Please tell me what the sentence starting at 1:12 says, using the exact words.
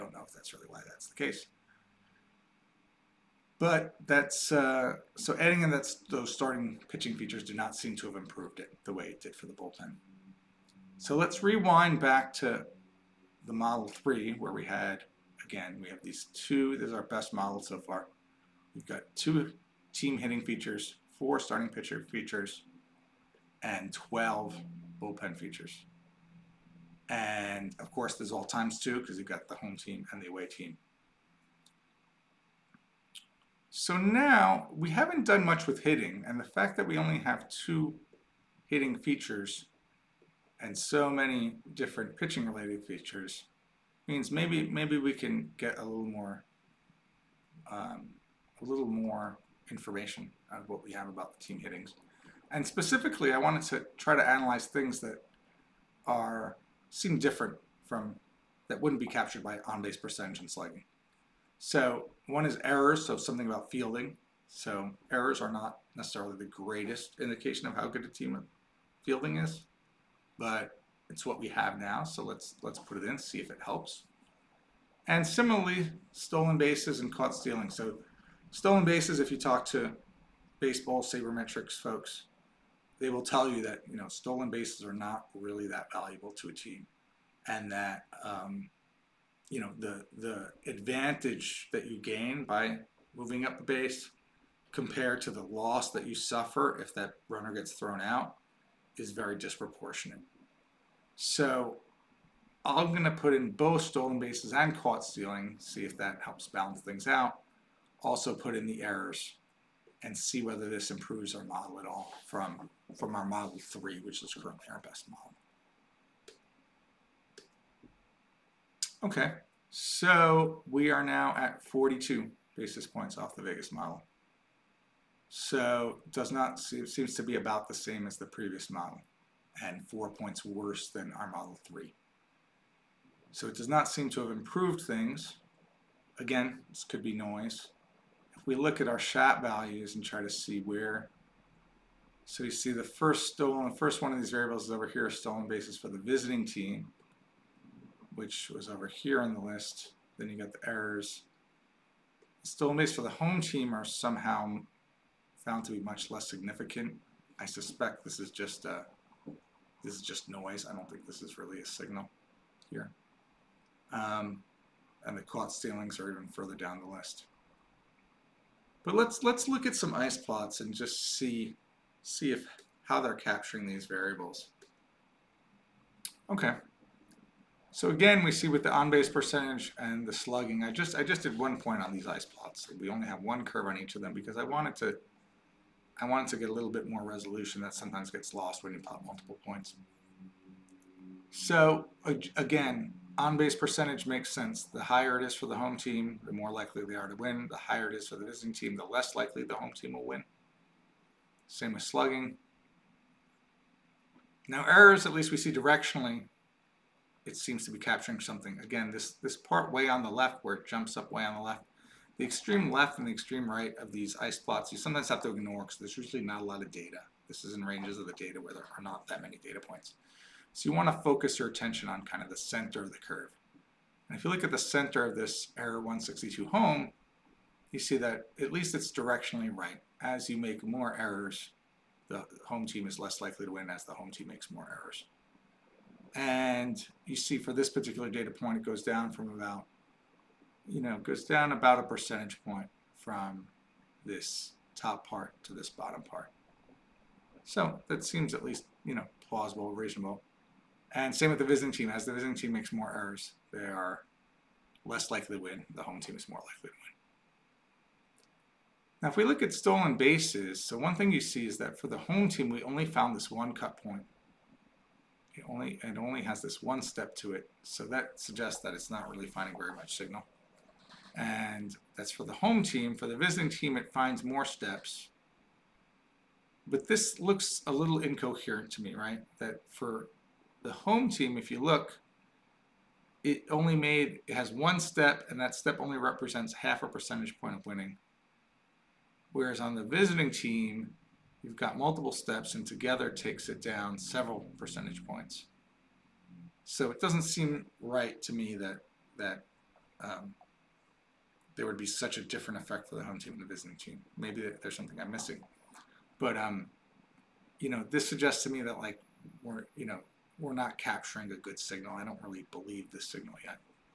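So let's let's put it in, see if it helps.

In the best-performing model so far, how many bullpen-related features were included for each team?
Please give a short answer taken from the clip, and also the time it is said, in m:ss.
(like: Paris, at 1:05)
12, at 0:23.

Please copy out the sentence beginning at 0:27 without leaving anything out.
And of course, there's all times two because you've got the home team and the away team.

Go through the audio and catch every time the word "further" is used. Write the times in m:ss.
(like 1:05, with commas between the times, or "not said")
2:46.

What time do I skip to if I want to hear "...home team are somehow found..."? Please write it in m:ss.
2:33.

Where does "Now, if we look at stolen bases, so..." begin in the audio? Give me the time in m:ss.
4:19.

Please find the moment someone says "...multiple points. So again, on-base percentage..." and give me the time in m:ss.
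3:09.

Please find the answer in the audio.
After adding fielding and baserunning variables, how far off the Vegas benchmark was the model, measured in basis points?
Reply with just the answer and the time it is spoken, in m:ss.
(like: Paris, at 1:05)
42, at 2:01.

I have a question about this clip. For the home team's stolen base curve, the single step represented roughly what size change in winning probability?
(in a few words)
Half a percentage point.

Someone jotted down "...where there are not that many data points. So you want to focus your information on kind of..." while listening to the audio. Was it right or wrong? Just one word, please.
wrong.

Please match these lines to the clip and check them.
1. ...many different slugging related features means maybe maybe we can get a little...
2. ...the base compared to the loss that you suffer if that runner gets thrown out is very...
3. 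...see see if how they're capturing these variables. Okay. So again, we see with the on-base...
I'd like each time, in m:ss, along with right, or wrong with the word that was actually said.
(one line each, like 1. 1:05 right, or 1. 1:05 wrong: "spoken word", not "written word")
1. 0:41 wrong: "pitching", not "slugging"
2. 1:33 right
3. 2:51 right.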